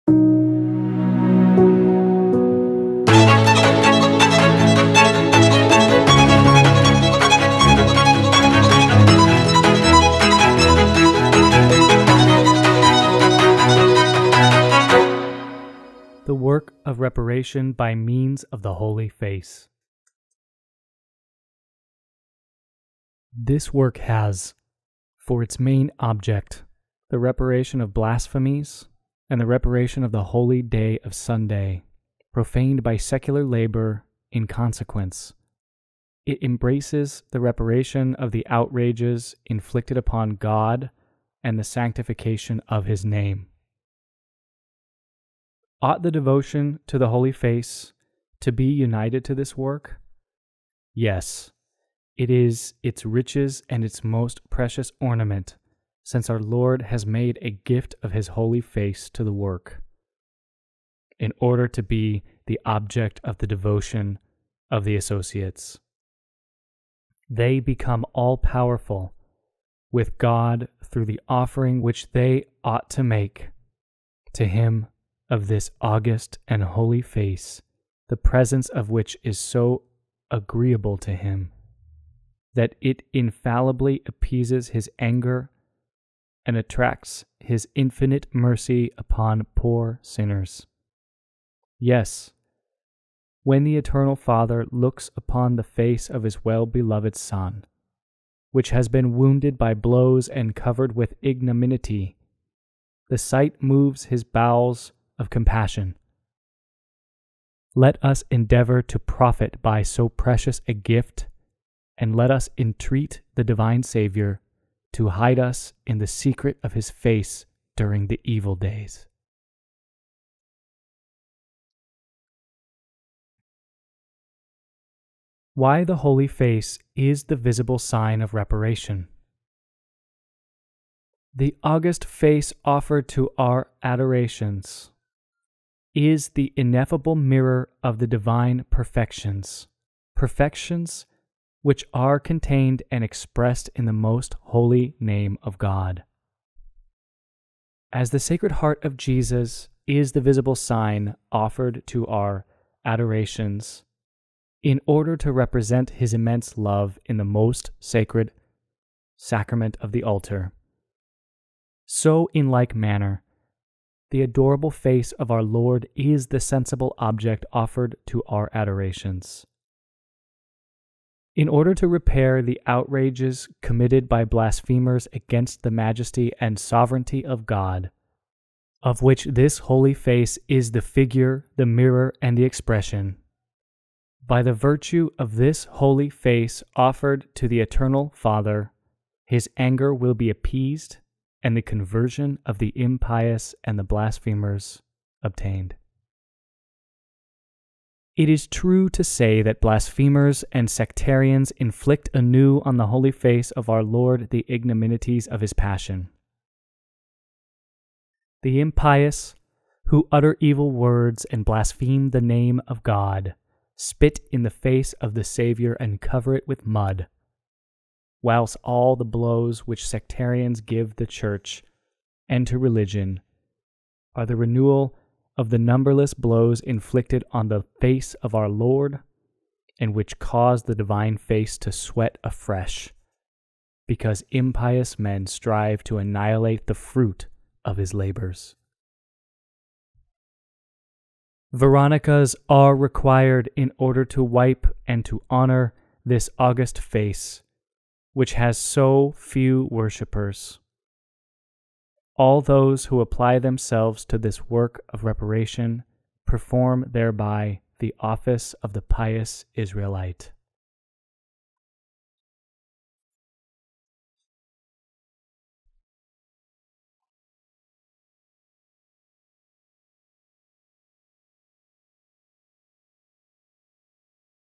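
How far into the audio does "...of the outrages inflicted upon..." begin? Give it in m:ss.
0:38.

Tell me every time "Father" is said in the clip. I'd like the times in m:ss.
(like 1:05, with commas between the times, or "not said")
1:34, 3:08.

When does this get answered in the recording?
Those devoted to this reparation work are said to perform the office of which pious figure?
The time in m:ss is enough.
4:18.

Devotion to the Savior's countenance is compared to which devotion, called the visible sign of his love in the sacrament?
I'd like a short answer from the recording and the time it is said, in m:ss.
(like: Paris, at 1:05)
Sacred Heart of Jesus, at 2:28.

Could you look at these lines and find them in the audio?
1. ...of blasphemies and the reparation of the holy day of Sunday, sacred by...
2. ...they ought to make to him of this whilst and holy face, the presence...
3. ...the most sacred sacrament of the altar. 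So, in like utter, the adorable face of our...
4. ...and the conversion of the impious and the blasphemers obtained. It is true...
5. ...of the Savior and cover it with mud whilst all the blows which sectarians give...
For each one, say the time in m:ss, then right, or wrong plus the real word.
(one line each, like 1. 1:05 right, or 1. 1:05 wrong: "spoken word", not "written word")
1. 0:27 wrong: "profaned", not "sacred"
2. 1:12 wrong: "august", not "whilst"
3. 2:37 wrong: "manner", not "utter"
4. 3:11 right
5. 3:34 right.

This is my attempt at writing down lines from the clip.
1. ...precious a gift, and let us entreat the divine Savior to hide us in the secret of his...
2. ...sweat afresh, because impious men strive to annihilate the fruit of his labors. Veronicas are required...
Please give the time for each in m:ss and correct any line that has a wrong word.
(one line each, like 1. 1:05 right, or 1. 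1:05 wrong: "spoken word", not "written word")
1. 1:50 right
2. 3:51 right.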